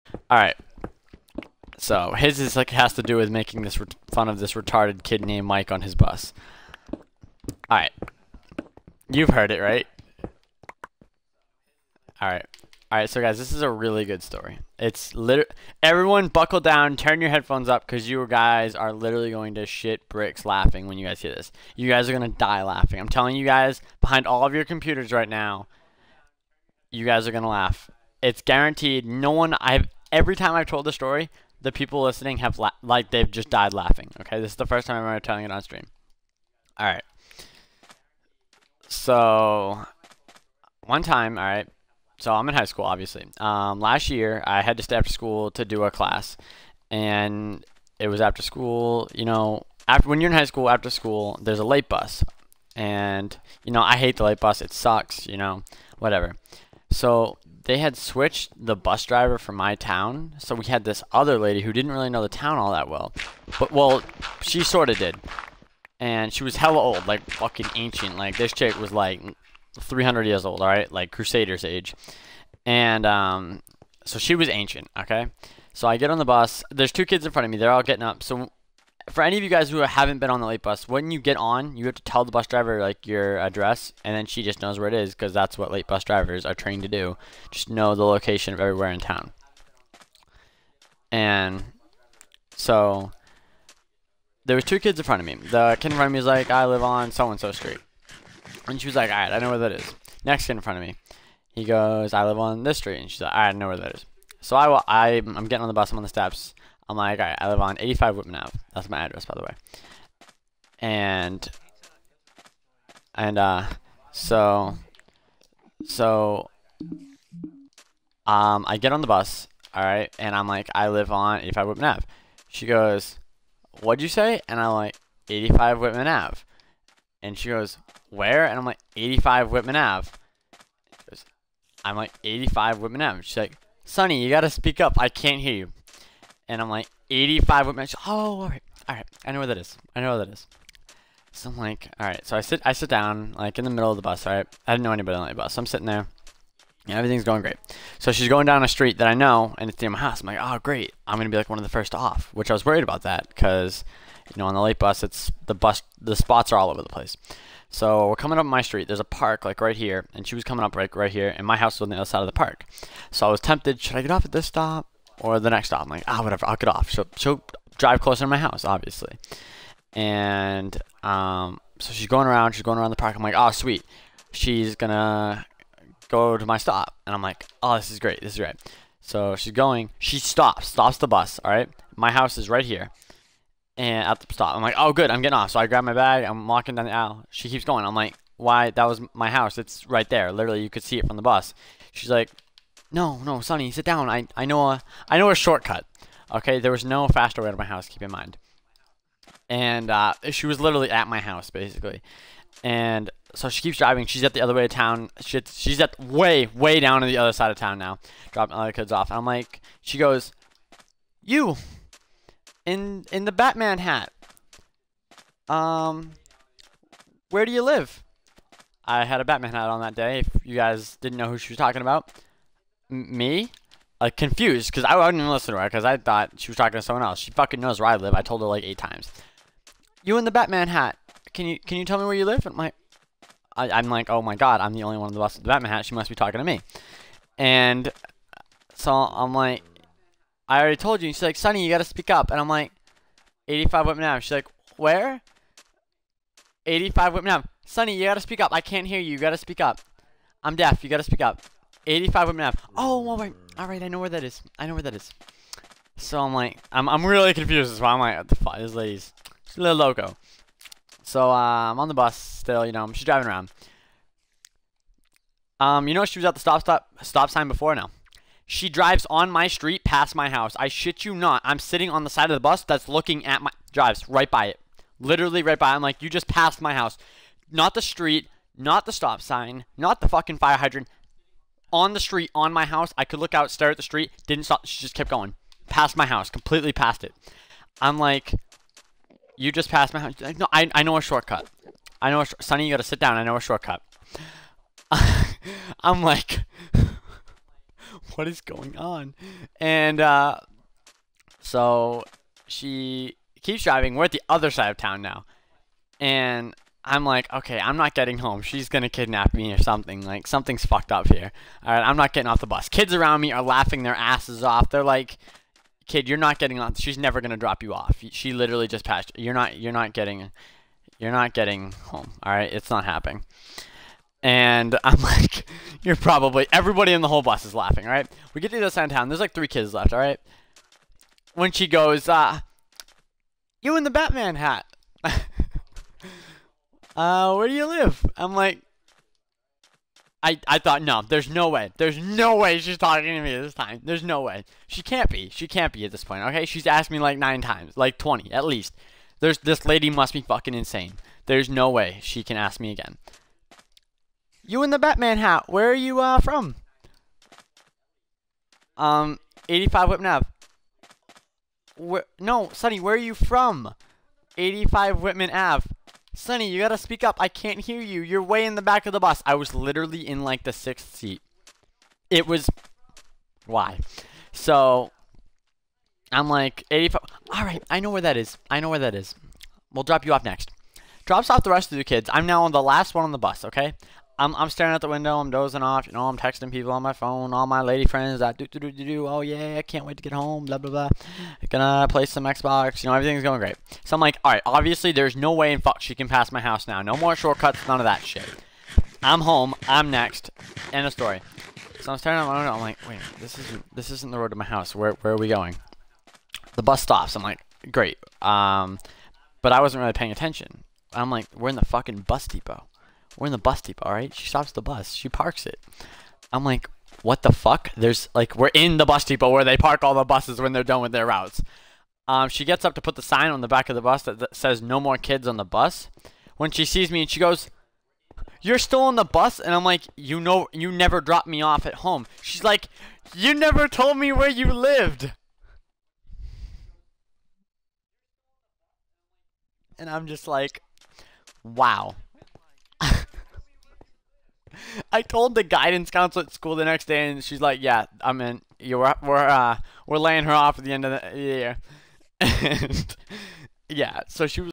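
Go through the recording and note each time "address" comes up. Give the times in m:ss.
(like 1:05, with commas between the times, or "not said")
1:23, 1:48.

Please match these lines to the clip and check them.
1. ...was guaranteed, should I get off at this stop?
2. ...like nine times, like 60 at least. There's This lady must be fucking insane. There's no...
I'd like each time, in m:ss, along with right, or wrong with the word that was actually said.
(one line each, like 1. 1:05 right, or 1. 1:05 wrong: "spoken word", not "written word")
1. 2:43 wrong: "tempted", not "guaranteed"
2. 5:46 wrong: "20", not "60".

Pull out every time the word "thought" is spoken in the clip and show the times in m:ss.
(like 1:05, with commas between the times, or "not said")
3:45, 5:40.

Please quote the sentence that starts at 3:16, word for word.
Okay, there was no faster way to my house, keep in mind.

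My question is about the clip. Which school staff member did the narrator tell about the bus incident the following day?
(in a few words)
guidance counselor.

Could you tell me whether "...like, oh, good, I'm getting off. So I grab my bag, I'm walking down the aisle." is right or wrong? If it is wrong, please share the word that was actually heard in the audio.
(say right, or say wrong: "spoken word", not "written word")
right.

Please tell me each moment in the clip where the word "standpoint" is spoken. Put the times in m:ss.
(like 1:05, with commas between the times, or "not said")
not said.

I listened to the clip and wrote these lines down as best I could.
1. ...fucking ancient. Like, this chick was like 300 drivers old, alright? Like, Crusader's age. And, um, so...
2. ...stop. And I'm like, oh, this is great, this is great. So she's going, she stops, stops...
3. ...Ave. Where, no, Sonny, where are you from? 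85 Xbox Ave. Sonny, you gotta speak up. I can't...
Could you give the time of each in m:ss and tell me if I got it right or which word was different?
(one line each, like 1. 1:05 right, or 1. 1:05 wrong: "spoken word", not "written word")
1. 1:07 wrong: "years", not "drivers"
2. 2:56 right
3. 6:00 wrong: "Whitman", not "Xbox".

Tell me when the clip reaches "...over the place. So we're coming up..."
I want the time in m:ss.
2:36.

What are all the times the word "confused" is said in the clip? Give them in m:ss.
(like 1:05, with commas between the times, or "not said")
3:44, 4:17.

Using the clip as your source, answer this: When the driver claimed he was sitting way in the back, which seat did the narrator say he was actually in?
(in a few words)
sixth seat.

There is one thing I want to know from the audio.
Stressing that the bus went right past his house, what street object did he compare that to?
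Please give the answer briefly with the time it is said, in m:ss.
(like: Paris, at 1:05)
fire hydrant, at 4:40.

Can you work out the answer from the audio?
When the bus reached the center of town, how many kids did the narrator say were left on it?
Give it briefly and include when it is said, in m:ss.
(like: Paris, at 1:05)
3, at 5:29.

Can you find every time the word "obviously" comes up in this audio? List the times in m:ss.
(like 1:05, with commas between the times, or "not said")
0:42, 2:48, 6:34.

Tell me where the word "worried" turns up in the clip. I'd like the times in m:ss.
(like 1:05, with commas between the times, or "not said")
2:32.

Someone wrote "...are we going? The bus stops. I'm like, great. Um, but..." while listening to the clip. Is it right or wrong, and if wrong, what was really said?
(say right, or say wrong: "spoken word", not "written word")
right.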